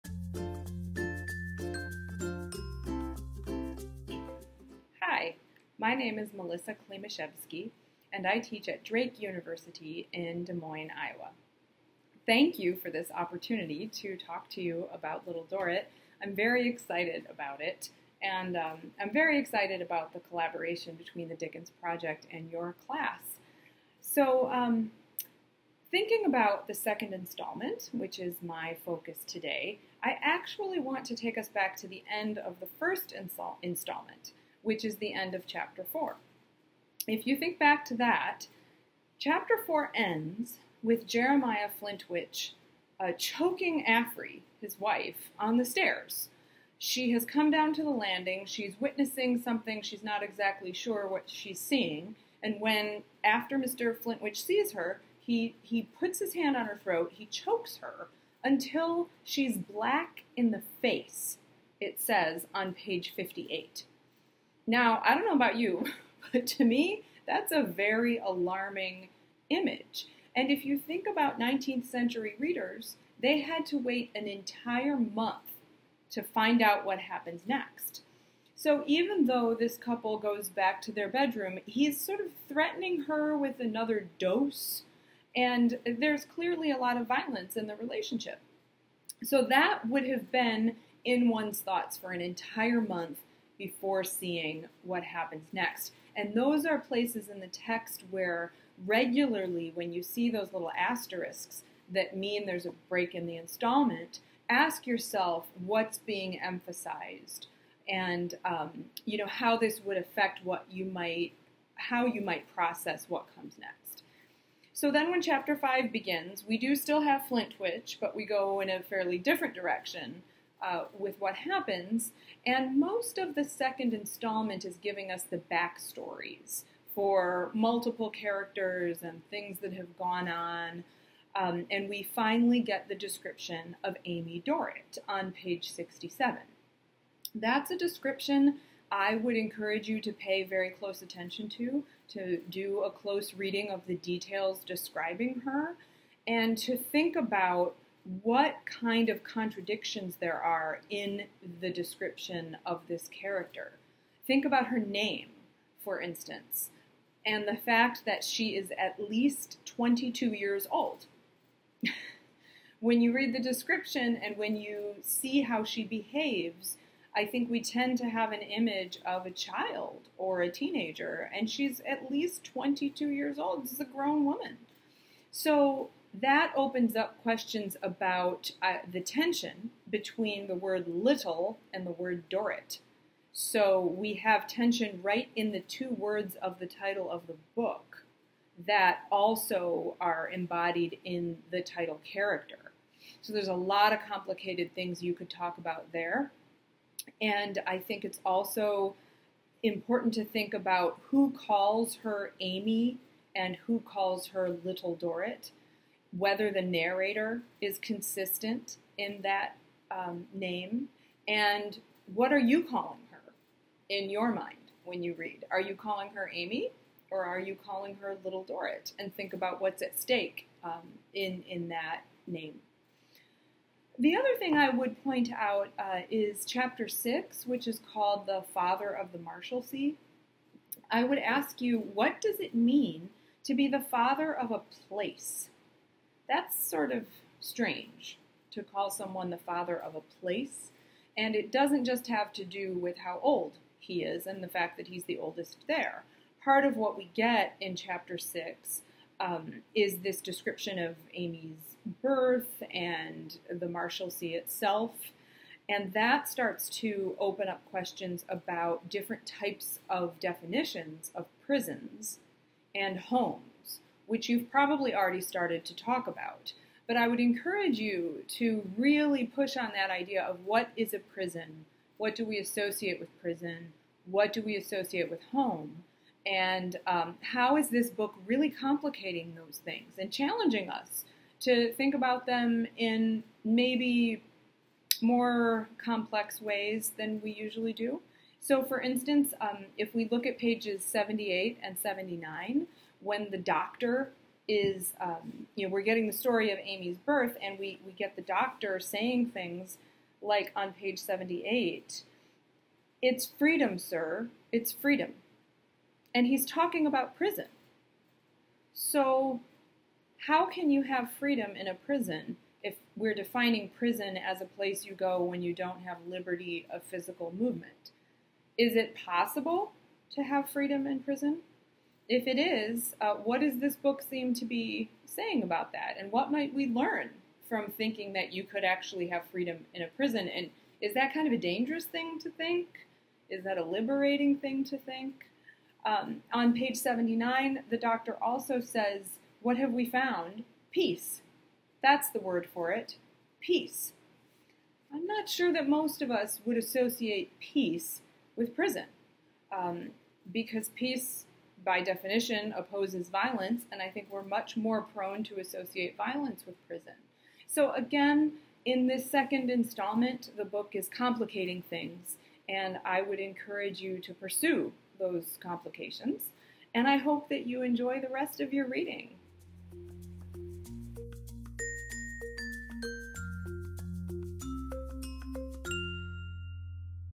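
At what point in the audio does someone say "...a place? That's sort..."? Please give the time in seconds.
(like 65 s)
234 s.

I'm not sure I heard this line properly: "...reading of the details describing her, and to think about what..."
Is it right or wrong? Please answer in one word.
right.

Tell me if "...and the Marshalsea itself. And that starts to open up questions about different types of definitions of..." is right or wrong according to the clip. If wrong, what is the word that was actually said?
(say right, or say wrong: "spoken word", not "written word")
right.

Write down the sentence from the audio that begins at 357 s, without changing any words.
So, again, in this second installment, the book is complicating things, and I would encourage you to pursue those complications.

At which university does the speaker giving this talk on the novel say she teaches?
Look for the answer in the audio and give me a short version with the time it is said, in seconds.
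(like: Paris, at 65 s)
Drake University, at 8 s.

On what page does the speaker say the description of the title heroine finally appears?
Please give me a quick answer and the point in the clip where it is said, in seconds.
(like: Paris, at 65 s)
67, at 135 s.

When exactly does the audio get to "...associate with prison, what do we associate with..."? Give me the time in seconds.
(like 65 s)
272 s.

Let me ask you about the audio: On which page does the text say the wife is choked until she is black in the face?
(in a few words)
58.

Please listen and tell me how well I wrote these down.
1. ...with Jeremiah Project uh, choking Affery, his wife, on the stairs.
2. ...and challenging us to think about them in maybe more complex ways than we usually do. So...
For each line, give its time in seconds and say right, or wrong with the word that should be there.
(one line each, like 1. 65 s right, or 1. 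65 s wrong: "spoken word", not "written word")
1. 40 s wrong: "Flintwinch", not "Project"
2. 279 s right.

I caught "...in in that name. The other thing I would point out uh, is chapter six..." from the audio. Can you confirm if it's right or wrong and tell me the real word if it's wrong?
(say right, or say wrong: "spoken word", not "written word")
right.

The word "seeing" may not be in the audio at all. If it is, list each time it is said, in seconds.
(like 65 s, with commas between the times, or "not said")
51 s, 94 s.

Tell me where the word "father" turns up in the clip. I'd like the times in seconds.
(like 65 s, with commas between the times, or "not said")
228 s, 233 s, 239 s.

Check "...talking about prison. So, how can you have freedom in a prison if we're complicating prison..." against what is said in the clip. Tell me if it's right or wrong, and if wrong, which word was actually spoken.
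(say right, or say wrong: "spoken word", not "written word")
wrong: "defining", not "complicating".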